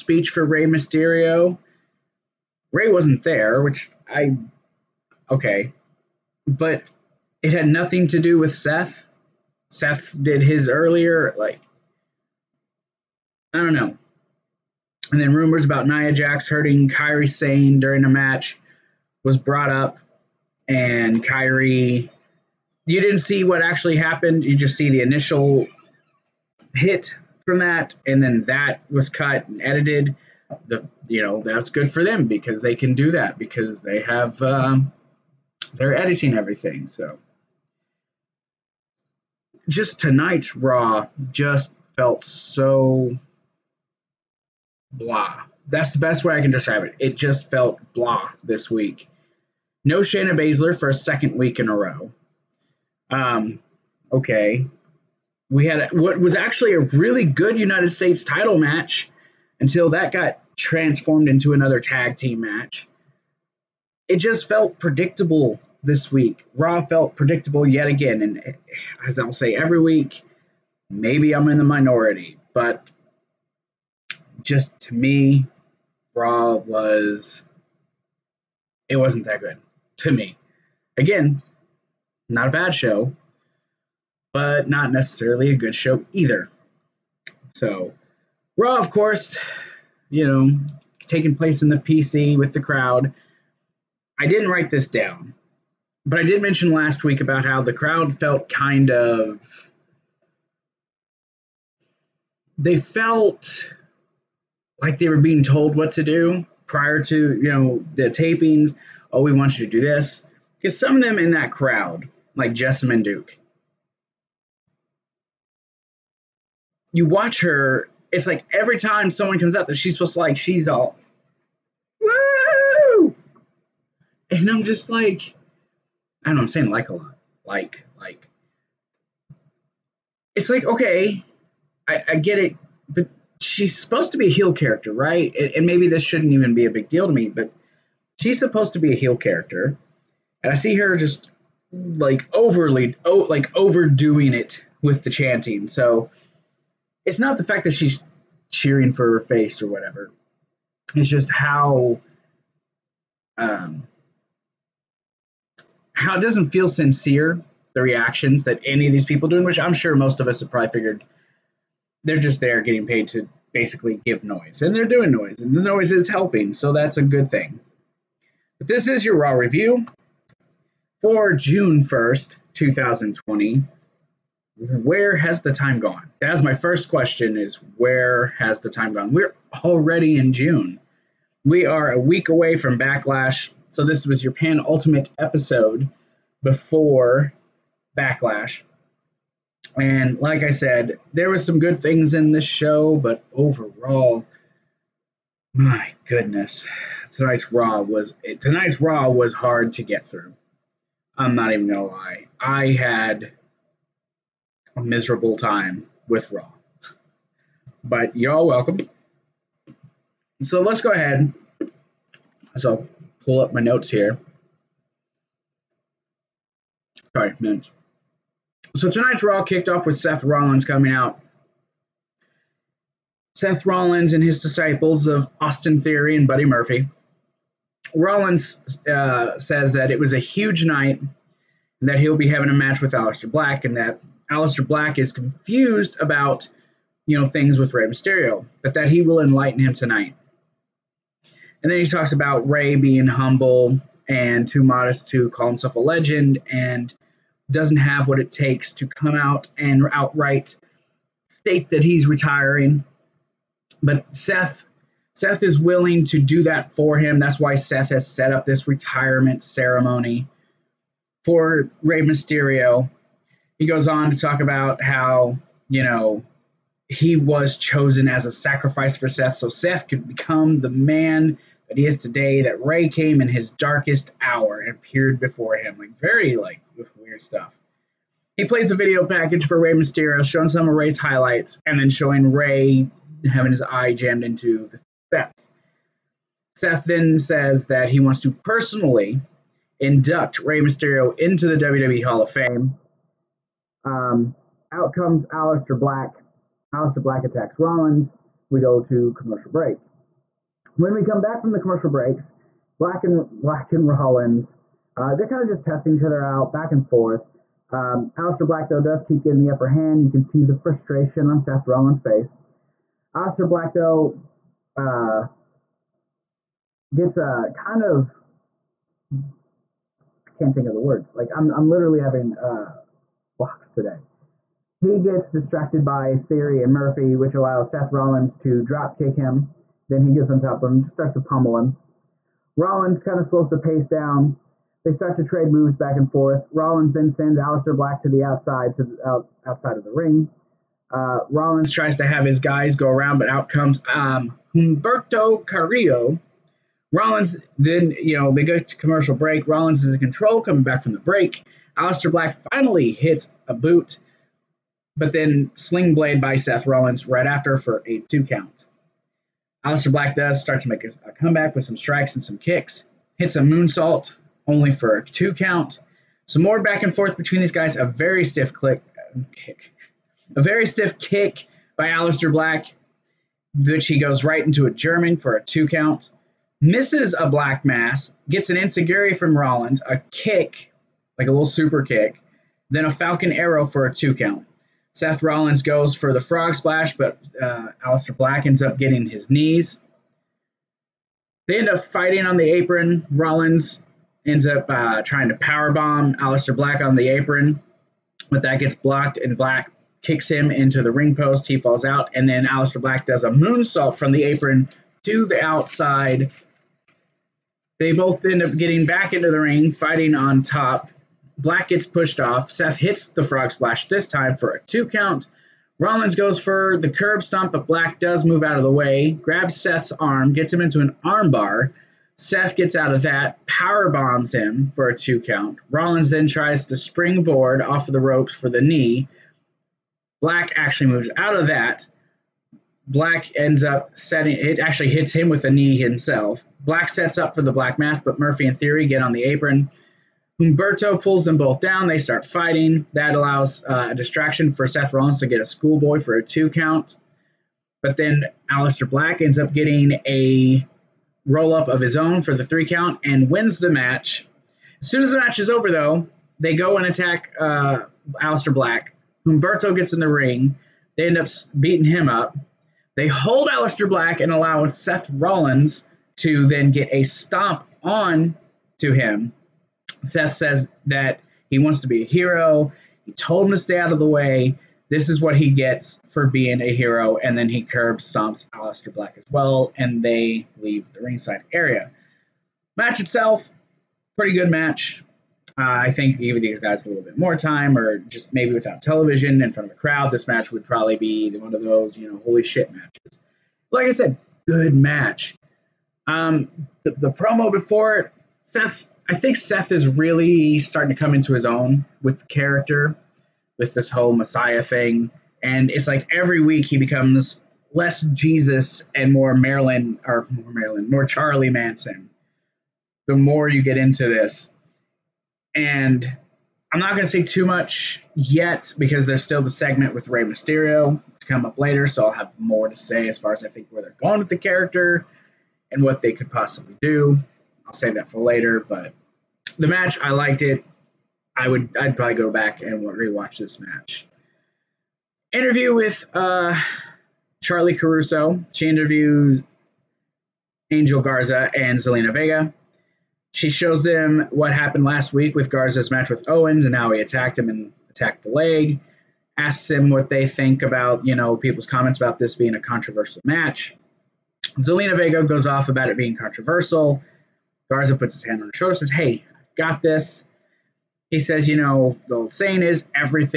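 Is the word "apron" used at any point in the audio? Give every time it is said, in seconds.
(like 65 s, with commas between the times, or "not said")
392 s, 397 s, 404 s, 439 s.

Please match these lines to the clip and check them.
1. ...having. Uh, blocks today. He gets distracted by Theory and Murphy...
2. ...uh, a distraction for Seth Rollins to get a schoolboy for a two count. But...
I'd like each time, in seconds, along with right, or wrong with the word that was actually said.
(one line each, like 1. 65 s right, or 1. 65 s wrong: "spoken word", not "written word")
1. 322 s right
2. 443 s right.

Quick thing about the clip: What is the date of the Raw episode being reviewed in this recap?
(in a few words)
June 1st, 2020.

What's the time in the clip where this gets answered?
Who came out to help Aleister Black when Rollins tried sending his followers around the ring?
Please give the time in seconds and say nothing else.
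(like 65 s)
344 s.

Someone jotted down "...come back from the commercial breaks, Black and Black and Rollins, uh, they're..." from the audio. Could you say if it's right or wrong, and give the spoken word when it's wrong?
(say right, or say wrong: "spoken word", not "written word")
right.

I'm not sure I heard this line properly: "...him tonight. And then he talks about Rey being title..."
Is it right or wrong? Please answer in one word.
wrong.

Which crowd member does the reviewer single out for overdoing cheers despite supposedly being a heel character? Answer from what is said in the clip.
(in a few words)
Jessamyn Duke.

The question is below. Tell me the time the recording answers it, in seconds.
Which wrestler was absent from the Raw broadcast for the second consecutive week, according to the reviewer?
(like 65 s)
50 s.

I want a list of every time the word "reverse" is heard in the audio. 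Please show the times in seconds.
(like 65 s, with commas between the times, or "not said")
not said.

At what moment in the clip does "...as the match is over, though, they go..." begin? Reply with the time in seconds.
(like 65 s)
455 s.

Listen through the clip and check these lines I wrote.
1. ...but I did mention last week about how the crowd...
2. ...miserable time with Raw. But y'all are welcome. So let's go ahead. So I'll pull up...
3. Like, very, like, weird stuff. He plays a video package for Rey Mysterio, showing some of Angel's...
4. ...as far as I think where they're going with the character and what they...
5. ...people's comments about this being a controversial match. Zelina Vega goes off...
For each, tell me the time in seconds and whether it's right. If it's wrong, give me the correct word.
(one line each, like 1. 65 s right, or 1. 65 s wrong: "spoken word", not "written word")
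1. 96 s right
2. 204 s right
3. 275 s wrong: "Rey", not "Angel"
4. 523 s right
5. 551 s right.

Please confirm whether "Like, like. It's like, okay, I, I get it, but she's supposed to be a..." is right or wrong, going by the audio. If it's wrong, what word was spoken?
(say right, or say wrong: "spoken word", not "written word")
right.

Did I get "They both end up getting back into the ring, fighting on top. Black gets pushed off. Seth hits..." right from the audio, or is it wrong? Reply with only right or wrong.
right.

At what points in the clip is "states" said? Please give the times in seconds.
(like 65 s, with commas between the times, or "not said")
57 s, 251 s.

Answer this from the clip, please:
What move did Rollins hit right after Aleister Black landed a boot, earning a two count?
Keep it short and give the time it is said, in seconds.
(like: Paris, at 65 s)
sling blade, at 355 s.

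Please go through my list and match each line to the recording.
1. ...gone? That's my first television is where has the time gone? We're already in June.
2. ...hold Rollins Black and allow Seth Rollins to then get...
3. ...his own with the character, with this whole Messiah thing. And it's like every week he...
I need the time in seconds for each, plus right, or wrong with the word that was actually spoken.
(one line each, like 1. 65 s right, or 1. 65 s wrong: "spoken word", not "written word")
1. 175 s wrong: "question", not "television"
2. 463 s wrong: "Aleister", not "Rollins"
3. 501 s right.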